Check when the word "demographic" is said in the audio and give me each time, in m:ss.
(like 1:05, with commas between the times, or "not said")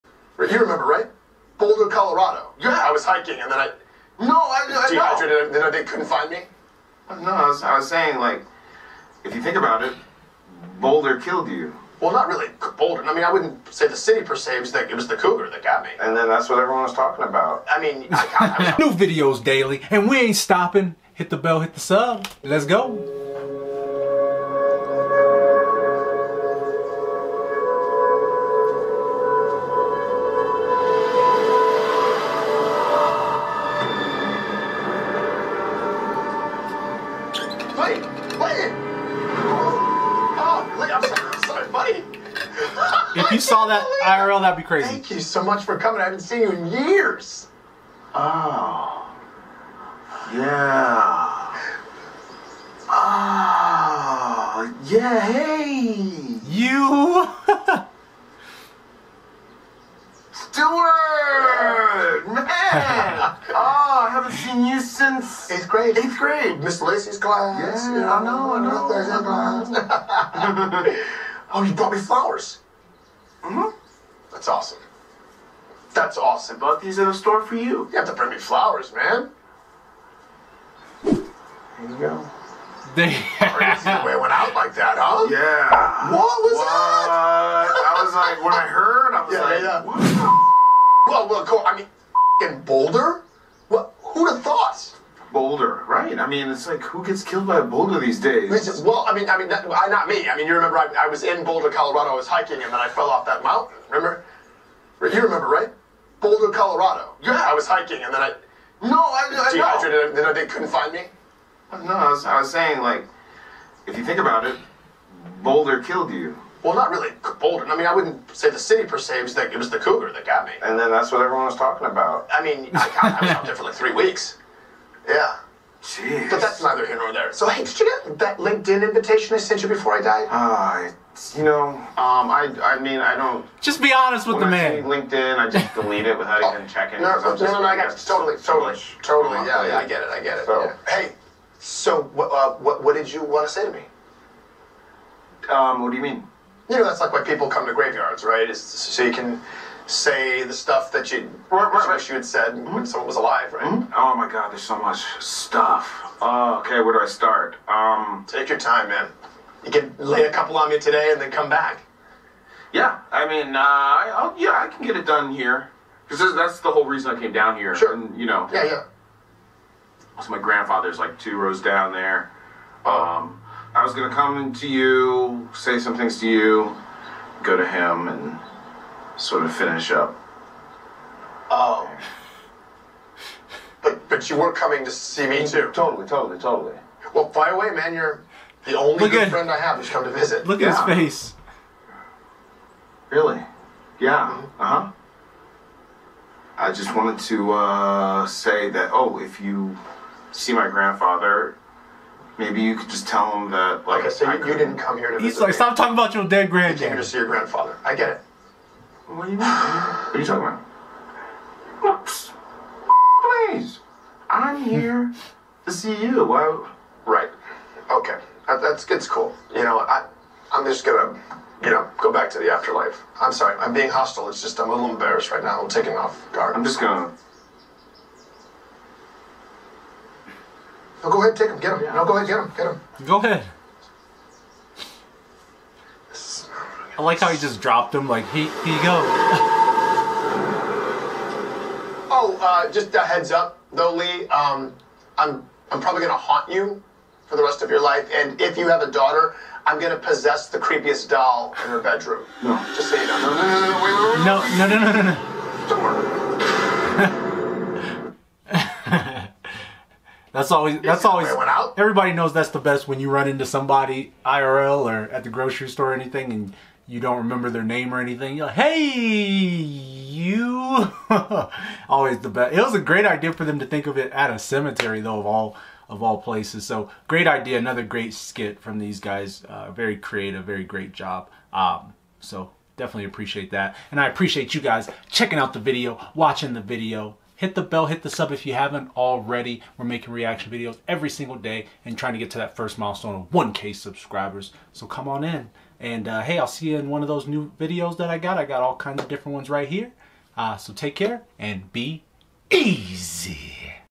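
not said.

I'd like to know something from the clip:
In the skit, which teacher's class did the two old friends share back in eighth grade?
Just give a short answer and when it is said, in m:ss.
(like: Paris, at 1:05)
Miss Lacey, at 1:06.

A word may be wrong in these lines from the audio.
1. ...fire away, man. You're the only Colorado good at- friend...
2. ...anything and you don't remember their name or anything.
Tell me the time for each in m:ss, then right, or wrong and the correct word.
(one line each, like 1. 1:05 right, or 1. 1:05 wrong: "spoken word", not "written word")
1. 3:07 wrong: "Look", not "Colorado"
2. 4:25 right.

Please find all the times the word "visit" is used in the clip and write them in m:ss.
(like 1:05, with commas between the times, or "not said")
3:10, 3:25.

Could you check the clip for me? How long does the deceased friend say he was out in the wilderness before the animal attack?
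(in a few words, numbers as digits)
three weeks.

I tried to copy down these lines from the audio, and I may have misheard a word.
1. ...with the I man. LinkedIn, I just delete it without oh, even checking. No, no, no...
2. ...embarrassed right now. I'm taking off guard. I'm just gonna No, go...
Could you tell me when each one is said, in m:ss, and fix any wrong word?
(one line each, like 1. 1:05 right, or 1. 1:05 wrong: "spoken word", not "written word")
1. 2:14 right
2. 3:44 right.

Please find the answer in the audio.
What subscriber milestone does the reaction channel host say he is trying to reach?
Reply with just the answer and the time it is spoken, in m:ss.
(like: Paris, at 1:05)
1K, at 4:53.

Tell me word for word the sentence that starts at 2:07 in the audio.
So, hey, did you get that LinkedIn invitation I sent you before I died?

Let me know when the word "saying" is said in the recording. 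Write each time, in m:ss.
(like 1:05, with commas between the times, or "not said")
0:07, 1:52.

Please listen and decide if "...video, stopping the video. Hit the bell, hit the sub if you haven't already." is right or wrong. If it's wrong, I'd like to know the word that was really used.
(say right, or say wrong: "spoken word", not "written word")
wrong: "watching", not "stopping".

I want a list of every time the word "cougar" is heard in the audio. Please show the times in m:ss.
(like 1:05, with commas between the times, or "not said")
0:15, 1:59.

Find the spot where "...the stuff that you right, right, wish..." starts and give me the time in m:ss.
2:30.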